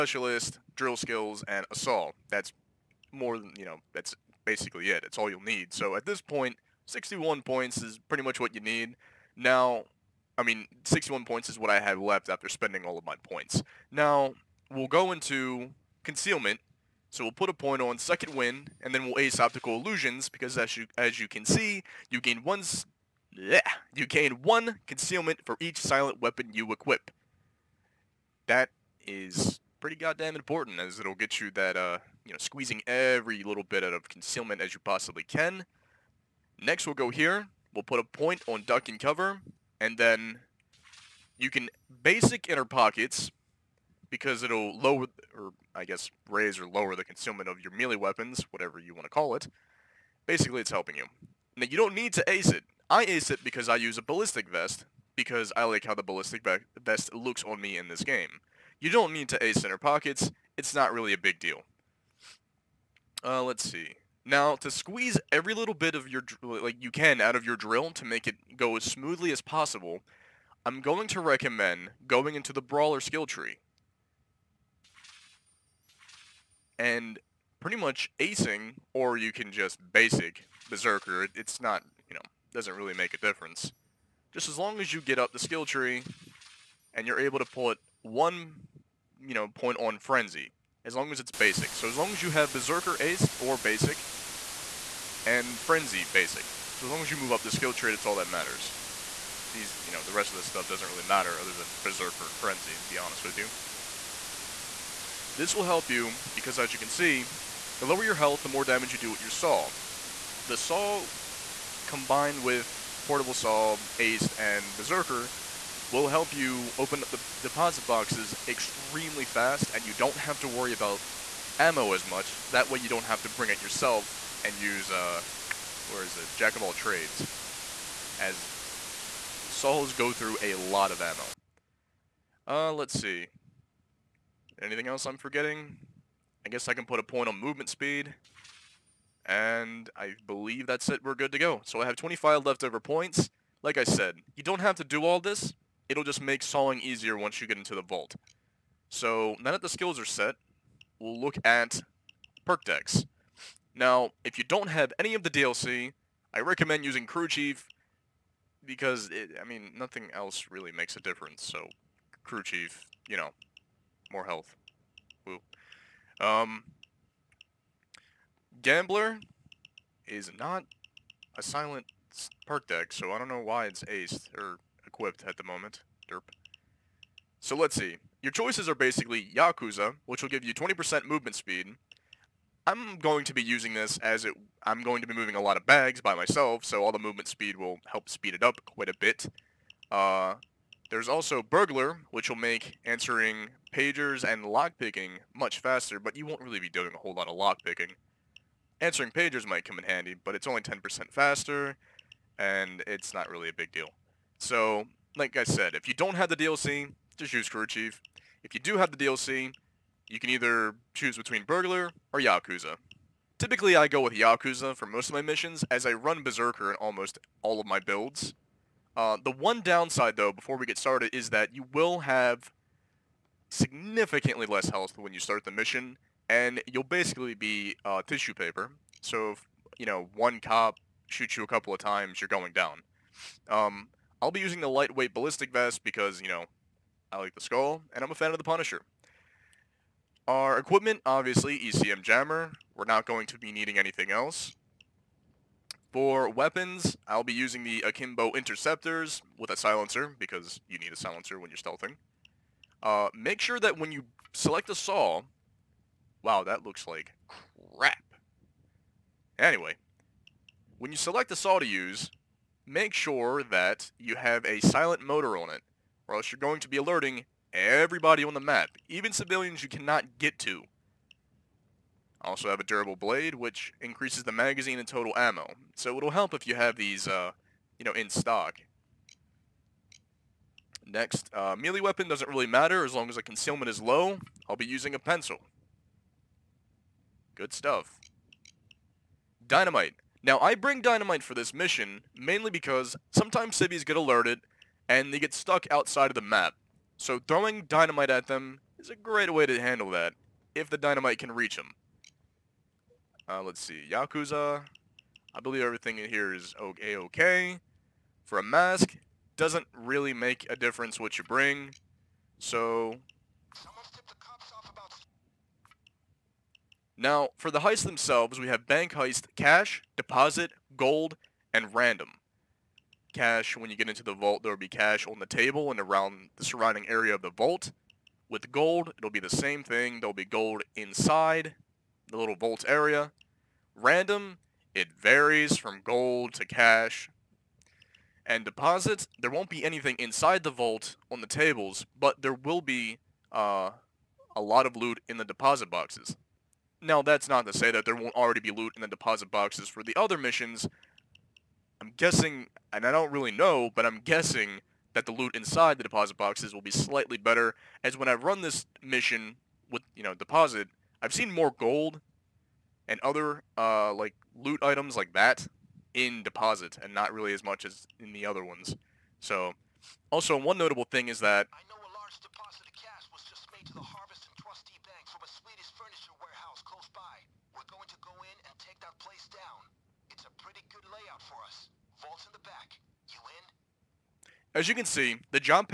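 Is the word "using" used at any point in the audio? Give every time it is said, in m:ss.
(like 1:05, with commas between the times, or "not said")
2:36, 3:03, 3:54, 4:07, 4:44.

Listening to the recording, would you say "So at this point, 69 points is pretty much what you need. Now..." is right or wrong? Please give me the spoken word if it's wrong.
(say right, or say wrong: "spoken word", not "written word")
wrong: "61", not "69".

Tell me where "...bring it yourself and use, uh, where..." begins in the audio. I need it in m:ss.
2:03.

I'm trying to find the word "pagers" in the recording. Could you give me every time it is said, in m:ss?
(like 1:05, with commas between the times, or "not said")
3:13, 3:19.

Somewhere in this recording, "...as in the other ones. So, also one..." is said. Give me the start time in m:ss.
6:07.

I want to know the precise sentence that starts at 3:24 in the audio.
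So, like I said, if you don't have the DLC, just use Crew Chief.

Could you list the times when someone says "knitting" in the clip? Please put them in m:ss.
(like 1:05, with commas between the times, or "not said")
not said.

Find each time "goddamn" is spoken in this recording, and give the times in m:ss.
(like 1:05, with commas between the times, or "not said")
0:29.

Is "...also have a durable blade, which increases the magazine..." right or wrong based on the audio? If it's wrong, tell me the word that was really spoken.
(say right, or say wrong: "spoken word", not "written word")
right.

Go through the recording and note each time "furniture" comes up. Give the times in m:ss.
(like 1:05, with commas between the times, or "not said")
6:15.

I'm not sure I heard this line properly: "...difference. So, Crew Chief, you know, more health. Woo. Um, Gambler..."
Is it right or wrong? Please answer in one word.
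right.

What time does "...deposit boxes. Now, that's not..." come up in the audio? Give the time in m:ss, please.
5:45.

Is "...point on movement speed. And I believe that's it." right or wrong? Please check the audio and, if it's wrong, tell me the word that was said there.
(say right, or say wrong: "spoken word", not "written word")
right.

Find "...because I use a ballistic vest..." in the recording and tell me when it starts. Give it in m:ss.
0:53.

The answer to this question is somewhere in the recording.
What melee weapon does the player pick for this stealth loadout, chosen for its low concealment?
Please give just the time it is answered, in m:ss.
4:44.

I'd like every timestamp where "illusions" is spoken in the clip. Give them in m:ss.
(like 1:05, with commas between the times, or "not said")
0:19.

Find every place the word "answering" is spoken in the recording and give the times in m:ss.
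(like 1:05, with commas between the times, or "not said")
3:12, 3:18.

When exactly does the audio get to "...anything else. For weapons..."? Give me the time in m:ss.
4:03.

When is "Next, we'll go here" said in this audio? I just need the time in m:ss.
0:36.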